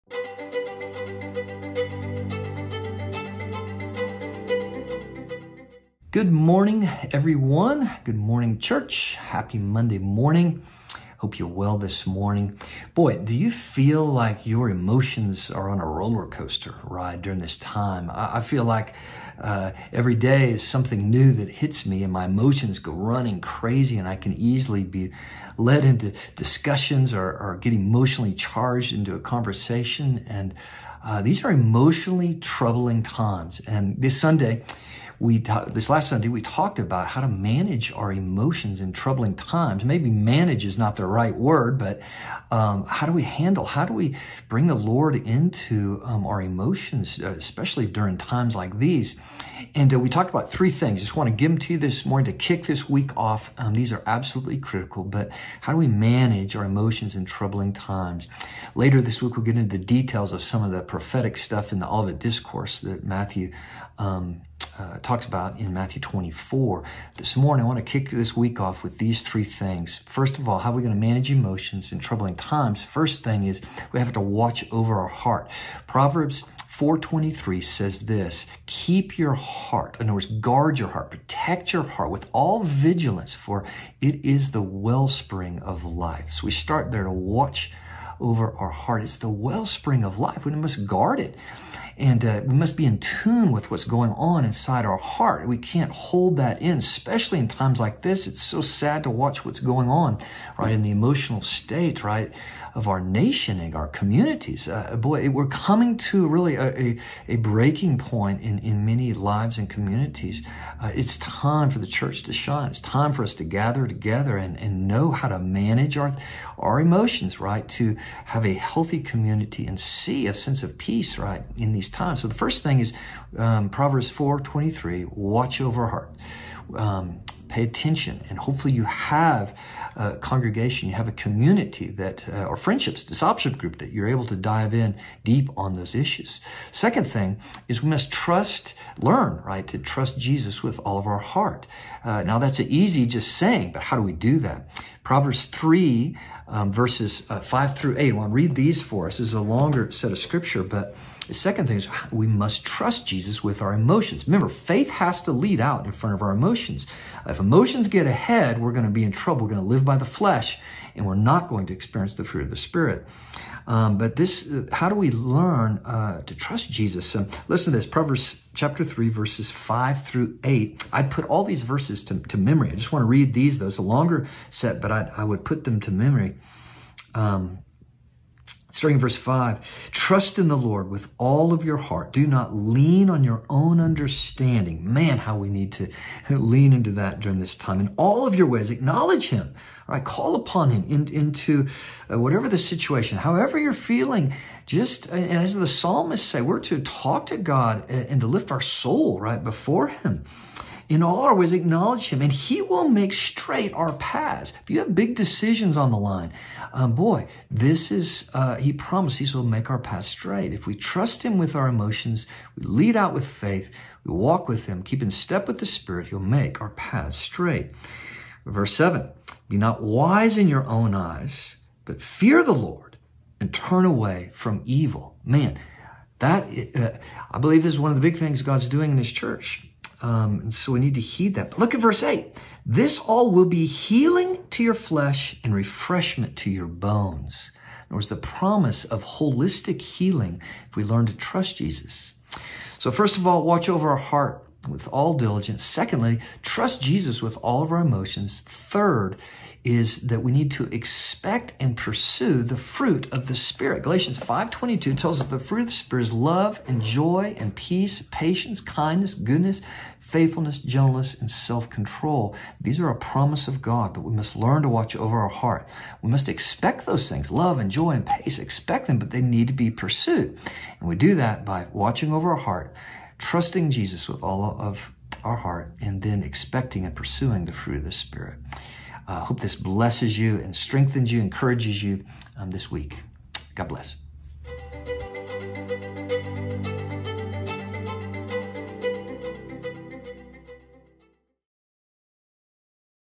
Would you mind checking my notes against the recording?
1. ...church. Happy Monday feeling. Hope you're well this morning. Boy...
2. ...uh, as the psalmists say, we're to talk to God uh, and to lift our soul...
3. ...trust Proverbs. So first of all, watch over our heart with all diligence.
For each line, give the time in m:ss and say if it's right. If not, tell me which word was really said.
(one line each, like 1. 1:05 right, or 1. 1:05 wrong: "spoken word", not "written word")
1. 0:08 wrong: "morning", not "feeling"
2. 3:15 right
3. 4:01 wrong: "Jesus", not "Proverbs".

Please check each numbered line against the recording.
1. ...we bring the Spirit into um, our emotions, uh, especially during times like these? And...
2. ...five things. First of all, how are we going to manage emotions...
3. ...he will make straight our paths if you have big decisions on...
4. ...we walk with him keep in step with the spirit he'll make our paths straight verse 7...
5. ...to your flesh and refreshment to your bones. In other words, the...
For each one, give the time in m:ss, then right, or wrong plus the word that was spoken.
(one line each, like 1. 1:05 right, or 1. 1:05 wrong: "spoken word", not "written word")
1. 0:43 wrong: "Lord", not "Spirit"
2. 1:09 wrong: "three", not "five"
3. 3:22 right
4. 3:34 right
5. 3:54 right.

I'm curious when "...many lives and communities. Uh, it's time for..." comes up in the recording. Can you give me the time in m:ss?
1:48.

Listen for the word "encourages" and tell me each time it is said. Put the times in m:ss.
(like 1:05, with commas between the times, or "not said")
4:41.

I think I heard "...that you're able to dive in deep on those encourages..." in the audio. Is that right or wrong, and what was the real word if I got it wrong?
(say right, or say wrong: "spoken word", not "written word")
wrong: "issues", not "encourages".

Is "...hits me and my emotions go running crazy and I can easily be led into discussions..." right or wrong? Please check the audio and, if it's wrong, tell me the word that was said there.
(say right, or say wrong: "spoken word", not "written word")
right.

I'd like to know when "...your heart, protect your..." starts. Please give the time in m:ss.
1:20.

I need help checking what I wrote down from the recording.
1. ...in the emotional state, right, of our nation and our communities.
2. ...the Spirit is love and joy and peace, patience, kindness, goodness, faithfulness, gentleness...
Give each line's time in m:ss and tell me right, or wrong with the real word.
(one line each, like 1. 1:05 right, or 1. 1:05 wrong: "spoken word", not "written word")
1. 1:40 right
2. 4:15 right.